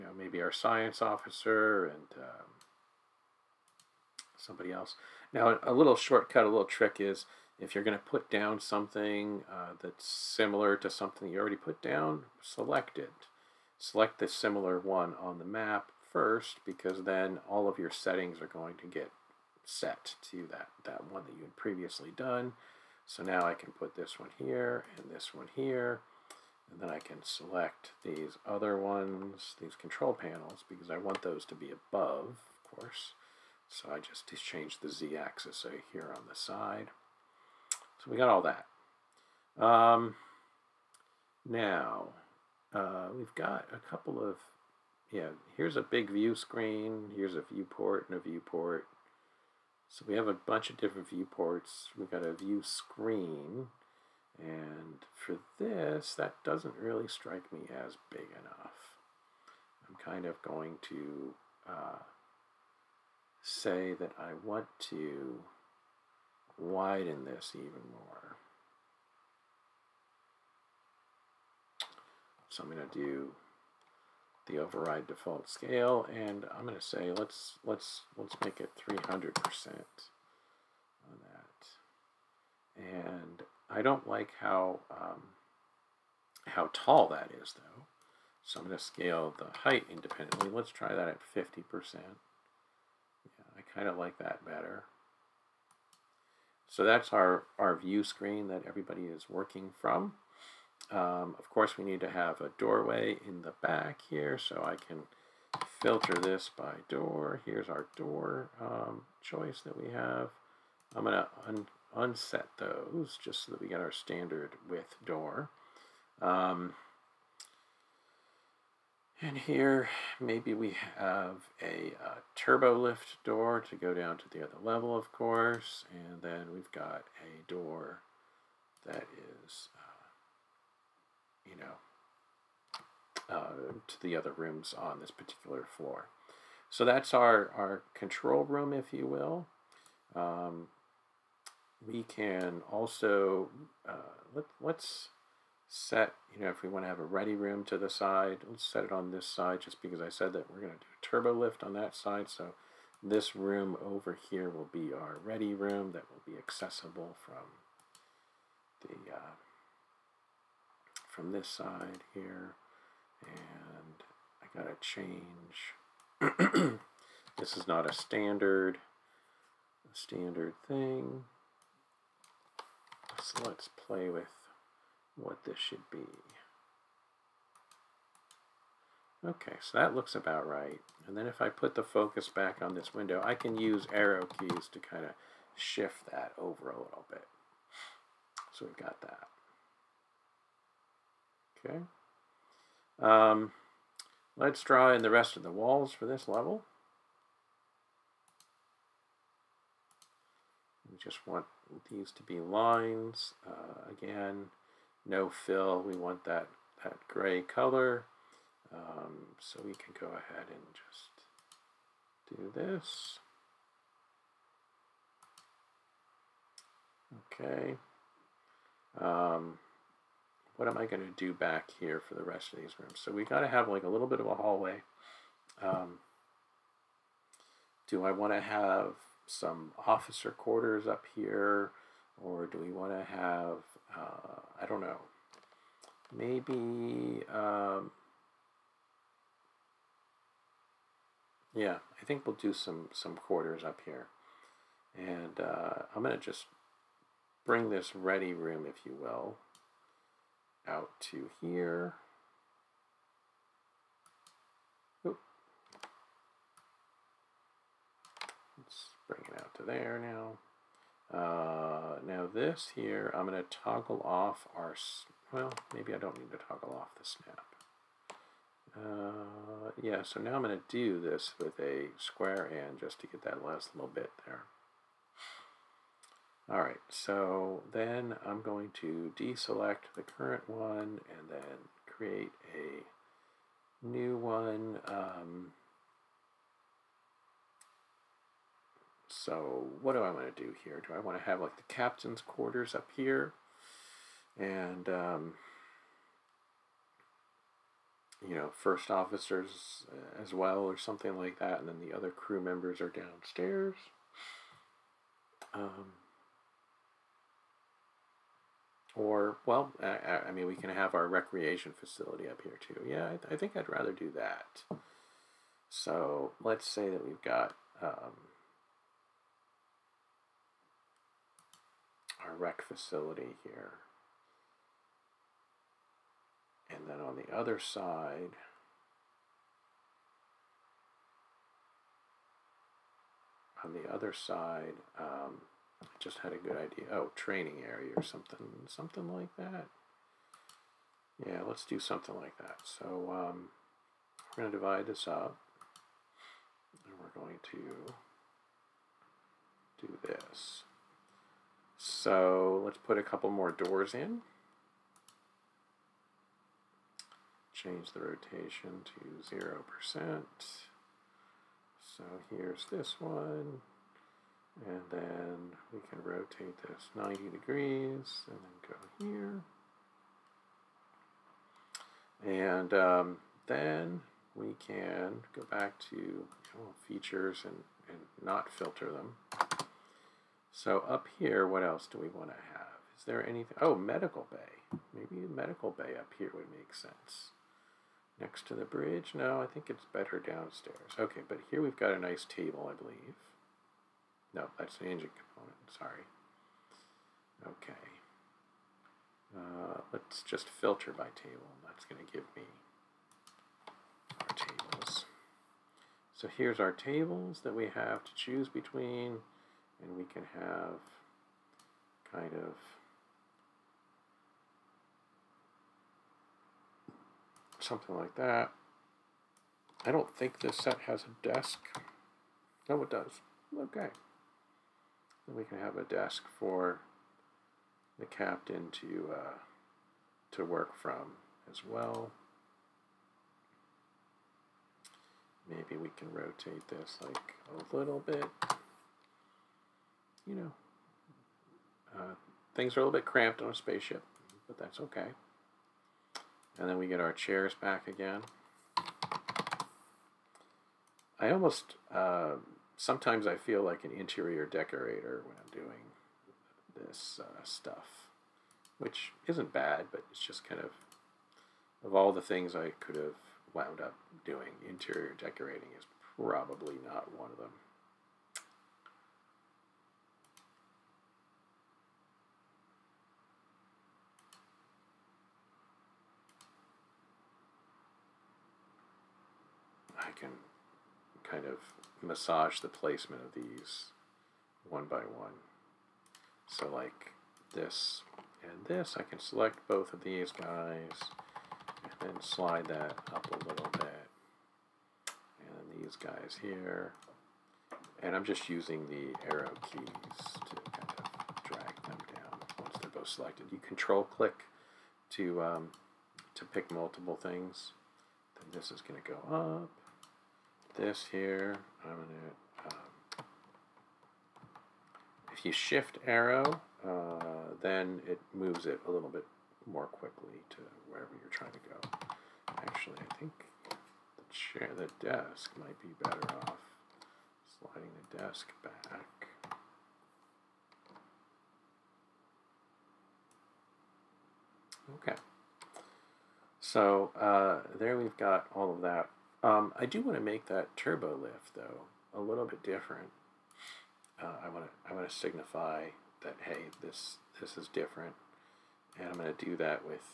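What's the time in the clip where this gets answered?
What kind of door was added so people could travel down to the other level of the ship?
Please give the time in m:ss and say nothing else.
2:02.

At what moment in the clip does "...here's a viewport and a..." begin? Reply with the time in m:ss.
0:47.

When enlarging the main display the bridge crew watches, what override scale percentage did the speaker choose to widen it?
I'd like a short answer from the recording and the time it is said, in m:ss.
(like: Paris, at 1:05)
300 percent, at 1:18.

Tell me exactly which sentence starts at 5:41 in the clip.
Yeah, let's do something like that.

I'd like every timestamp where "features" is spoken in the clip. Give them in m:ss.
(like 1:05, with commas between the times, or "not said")
6:16.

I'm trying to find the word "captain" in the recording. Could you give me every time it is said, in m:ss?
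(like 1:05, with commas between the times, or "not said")
4:51, 7:08.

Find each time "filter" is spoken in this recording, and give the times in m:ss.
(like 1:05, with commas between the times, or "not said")
1:45, 6:18, 6:40.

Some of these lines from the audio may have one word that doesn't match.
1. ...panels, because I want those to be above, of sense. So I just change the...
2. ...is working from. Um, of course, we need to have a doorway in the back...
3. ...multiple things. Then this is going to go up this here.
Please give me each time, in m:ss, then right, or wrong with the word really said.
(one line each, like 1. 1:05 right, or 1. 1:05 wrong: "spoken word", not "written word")
1. 0:30 wrong: "course", not "sense"
2. 1:39 right
3. 8:26 right.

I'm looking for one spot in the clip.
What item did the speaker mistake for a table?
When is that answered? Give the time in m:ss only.
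6:34.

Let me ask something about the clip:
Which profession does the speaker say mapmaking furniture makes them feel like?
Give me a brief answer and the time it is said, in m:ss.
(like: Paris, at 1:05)
interior decorator, at 7:33.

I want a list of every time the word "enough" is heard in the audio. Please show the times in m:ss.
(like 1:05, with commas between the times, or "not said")
0:58.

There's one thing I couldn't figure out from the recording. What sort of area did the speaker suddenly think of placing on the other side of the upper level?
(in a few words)
training area.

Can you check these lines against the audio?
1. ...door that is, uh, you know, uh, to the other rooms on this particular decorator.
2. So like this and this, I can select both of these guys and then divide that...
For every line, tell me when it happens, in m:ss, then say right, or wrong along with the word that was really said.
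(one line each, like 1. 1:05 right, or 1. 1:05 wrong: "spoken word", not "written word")
1. 2:07 wrong: "floor", not "decorator"
2. 8:06 wrong: "slide", not "divide".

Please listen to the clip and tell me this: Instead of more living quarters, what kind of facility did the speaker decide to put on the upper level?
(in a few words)
recreation facility.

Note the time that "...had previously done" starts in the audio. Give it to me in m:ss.
0:21.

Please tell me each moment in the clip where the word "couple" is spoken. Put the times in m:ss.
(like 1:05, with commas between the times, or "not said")
0:43, 5:53.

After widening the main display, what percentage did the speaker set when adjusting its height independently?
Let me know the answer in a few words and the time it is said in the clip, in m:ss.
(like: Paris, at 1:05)
50 percent, at 1:31.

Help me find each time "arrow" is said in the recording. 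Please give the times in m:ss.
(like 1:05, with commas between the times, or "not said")
3:03, 8:19, 8:36.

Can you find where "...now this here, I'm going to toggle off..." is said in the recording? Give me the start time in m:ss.
4:22.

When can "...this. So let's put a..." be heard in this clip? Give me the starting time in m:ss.
5:50.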